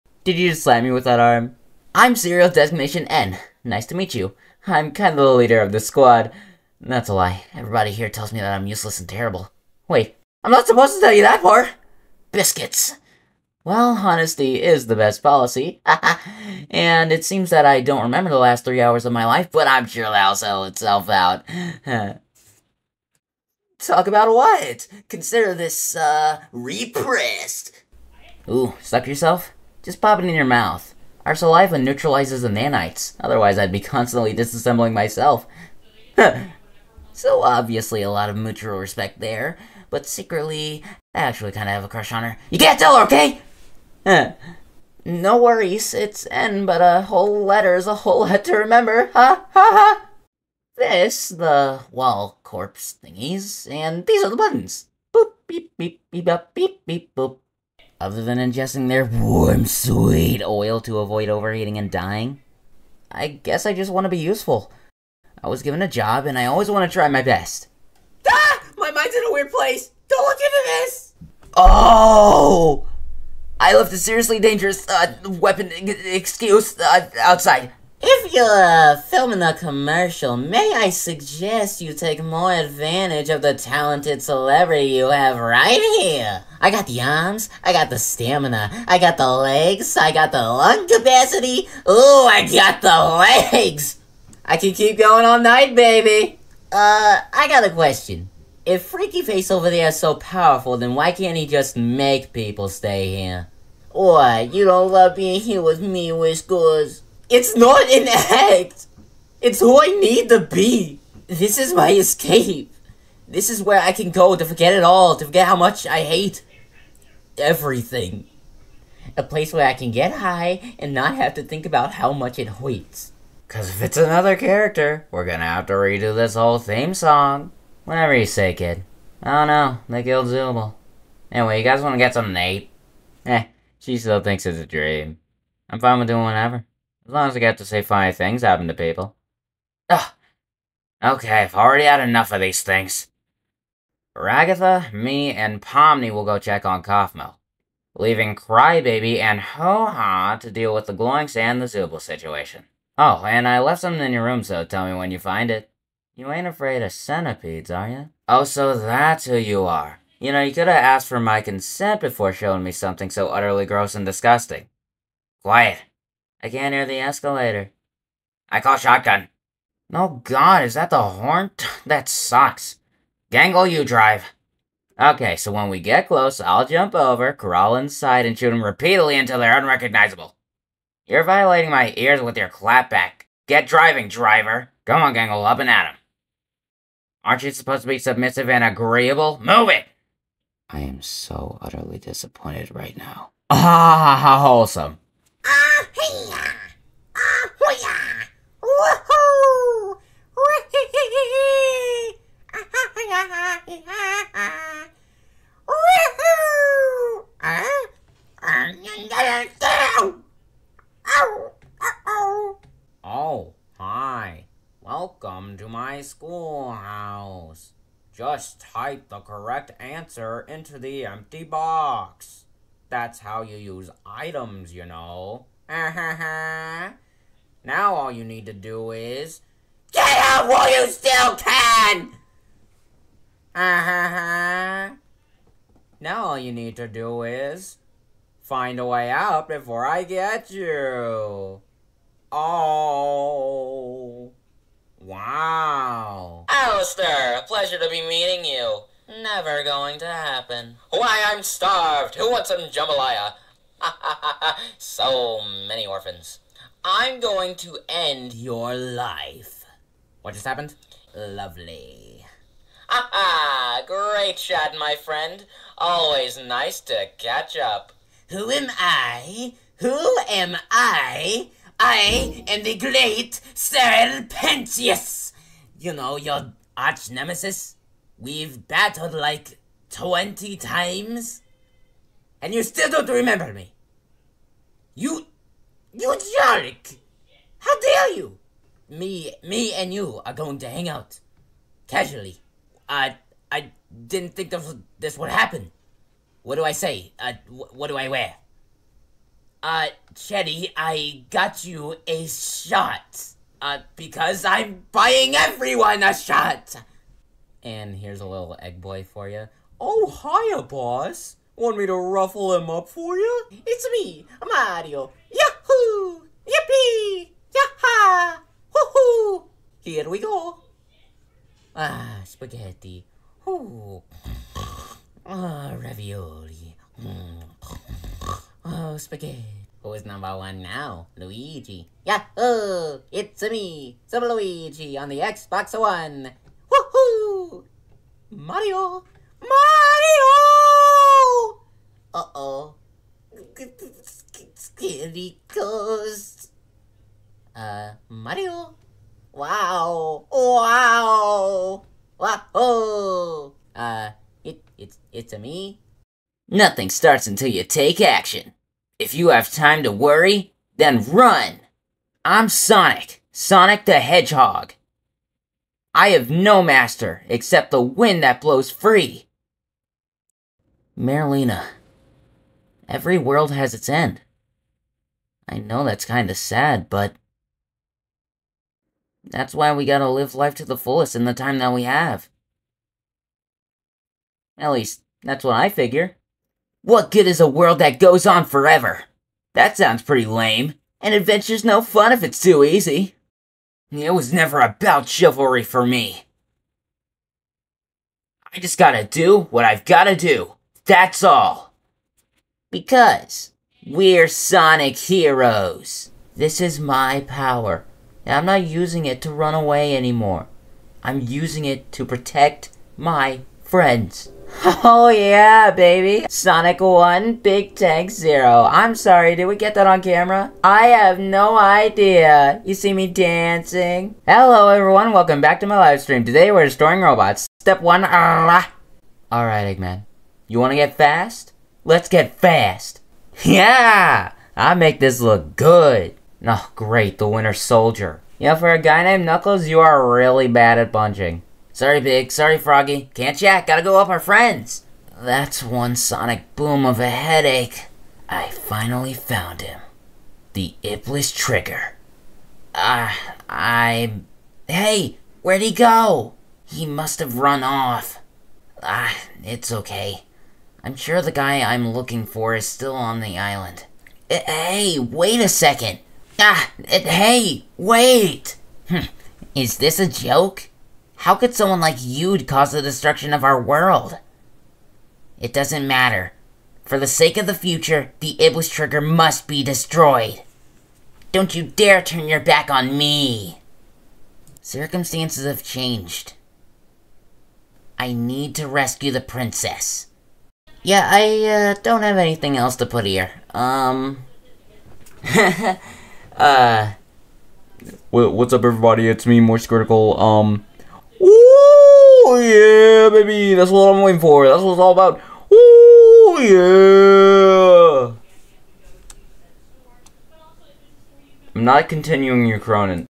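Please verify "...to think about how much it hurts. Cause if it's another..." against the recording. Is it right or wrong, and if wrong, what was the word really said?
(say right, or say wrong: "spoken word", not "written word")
right.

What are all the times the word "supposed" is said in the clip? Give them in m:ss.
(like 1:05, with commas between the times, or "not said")
0:10, 3:07.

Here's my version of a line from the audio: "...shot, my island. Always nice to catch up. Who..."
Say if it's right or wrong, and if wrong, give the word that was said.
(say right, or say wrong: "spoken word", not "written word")
wrong: "friend", not "island".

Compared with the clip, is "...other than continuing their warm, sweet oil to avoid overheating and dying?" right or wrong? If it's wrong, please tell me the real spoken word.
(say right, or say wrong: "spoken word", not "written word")
wrong: "ingesting", not "continuing".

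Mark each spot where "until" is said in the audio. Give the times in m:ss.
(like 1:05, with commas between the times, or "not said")
2:59, 5:57.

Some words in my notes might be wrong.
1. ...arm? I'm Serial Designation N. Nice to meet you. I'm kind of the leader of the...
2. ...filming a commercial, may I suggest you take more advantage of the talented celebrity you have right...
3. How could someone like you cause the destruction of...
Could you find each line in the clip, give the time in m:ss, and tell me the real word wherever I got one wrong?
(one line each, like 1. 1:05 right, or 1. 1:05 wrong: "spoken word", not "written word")
1. 0:01 right
2. 1:19 right
3. 7:51 right.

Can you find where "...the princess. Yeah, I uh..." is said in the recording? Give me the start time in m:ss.
8:09.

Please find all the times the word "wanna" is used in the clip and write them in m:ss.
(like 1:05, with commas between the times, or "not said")
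2:11, 7:10.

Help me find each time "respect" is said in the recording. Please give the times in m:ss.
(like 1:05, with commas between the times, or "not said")
0:38.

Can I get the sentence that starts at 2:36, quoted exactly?
You ain't afraid of centipedes, are you?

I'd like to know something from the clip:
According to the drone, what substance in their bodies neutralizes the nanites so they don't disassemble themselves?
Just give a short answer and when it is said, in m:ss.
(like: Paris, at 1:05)
Saliva, at 0:31.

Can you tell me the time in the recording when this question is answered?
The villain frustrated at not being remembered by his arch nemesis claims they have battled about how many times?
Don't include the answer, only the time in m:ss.
4:39.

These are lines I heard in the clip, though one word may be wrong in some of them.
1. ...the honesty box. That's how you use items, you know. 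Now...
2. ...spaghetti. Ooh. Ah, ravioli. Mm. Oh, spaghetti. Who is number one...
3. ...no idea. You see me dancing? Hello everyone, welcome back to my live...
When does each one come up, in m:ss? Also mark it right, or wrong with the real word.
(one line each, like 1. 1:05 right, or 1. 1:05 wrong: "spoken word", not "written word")
1. 3:40 wrong: "empty", not "honesty"
2. 5:22 right
3. 7:01 right.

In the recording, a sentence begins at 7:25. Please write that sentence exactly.
That's one sonic boom of a headache.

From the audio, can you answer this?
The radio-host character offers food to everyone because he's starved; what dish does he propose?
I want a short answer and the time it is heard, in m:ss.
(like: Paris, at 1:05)
Jambalaya, at 4:12.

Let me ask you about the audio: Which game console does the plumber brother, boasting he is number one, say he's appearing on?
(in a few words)
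Xbox One.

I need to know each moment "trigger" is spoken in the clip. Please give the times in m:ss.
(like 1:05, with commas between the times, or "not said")
7:31, 7:58.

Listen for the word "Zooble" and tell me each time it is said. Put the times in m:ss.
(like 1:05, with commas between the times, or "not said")
2:10, 2:31.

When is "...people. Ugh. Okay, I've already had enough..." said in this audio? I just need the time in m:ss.
2:18.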